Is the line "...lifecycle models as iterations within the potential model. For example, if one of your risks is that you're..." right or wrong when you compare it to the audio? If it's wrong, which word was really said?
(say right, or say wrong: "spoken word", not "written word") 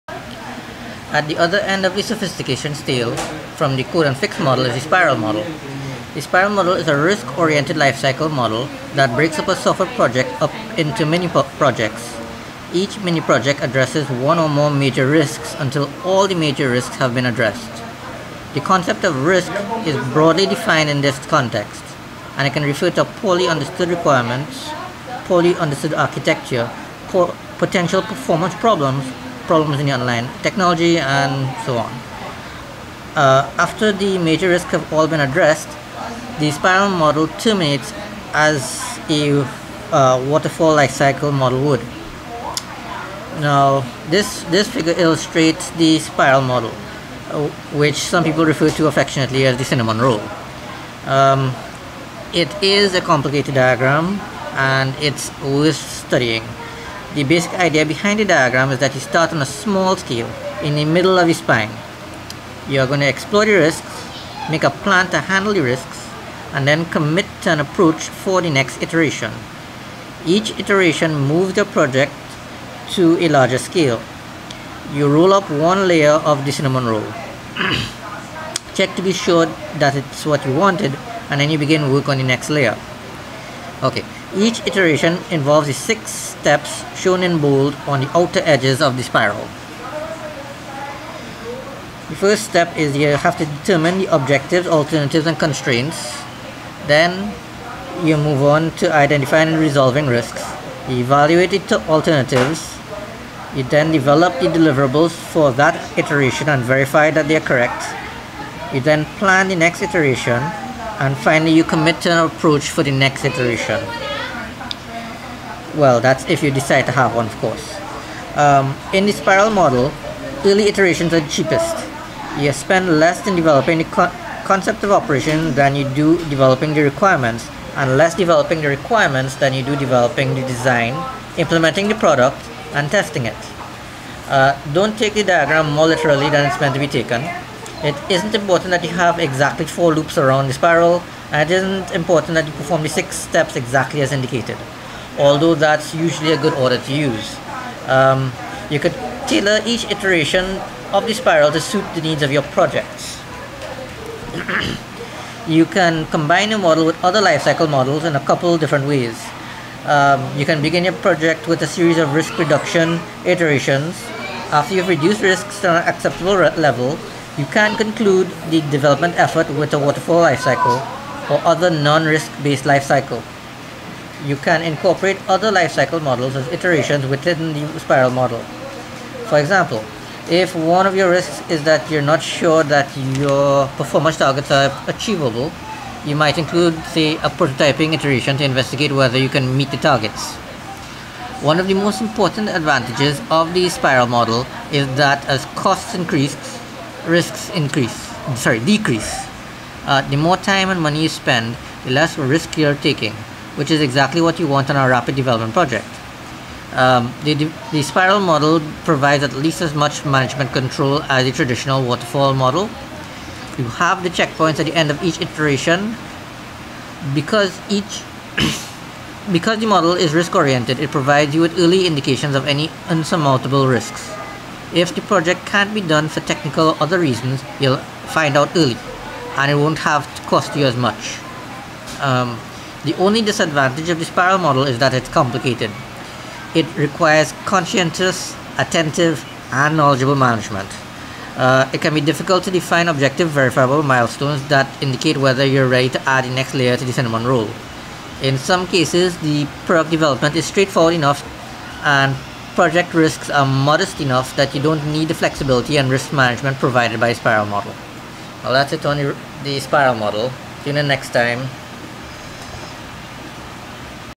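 wrong: "spiral", not "potential".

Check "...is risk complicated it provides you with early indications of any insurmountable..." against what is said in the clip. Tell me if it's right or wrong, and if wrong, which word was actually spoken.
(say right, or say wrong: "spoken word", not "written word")
wrong: "oriented", not "complicated".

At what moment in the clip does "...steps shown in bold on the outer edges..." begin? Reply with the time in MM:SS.
01:26.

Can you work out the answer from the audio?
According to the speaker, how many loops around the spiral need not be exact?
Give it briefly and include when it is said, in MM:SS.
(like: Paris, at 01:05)
4, at 02:19.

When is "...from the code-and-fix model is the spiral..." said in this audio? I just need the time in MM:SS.
00:03.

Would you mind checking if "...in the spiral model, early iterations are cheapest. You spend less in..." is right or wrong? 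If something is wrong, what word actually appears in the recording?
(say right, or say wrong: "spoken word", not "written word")
right.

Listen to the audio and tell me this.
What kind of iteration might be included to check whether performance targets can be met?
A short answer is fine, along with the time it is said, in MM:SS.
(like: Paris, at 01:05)
a prototyping iteration, at 03:07.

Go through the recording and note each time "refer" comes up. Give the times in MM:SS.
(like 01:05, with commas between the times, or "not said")
00:22, 00:48.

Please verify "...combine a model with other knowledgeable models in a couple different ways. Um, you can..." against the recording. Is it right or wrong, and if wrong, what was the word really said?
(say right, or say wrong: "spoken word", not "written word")
wrong: "lifecycle", not "knowledgeable".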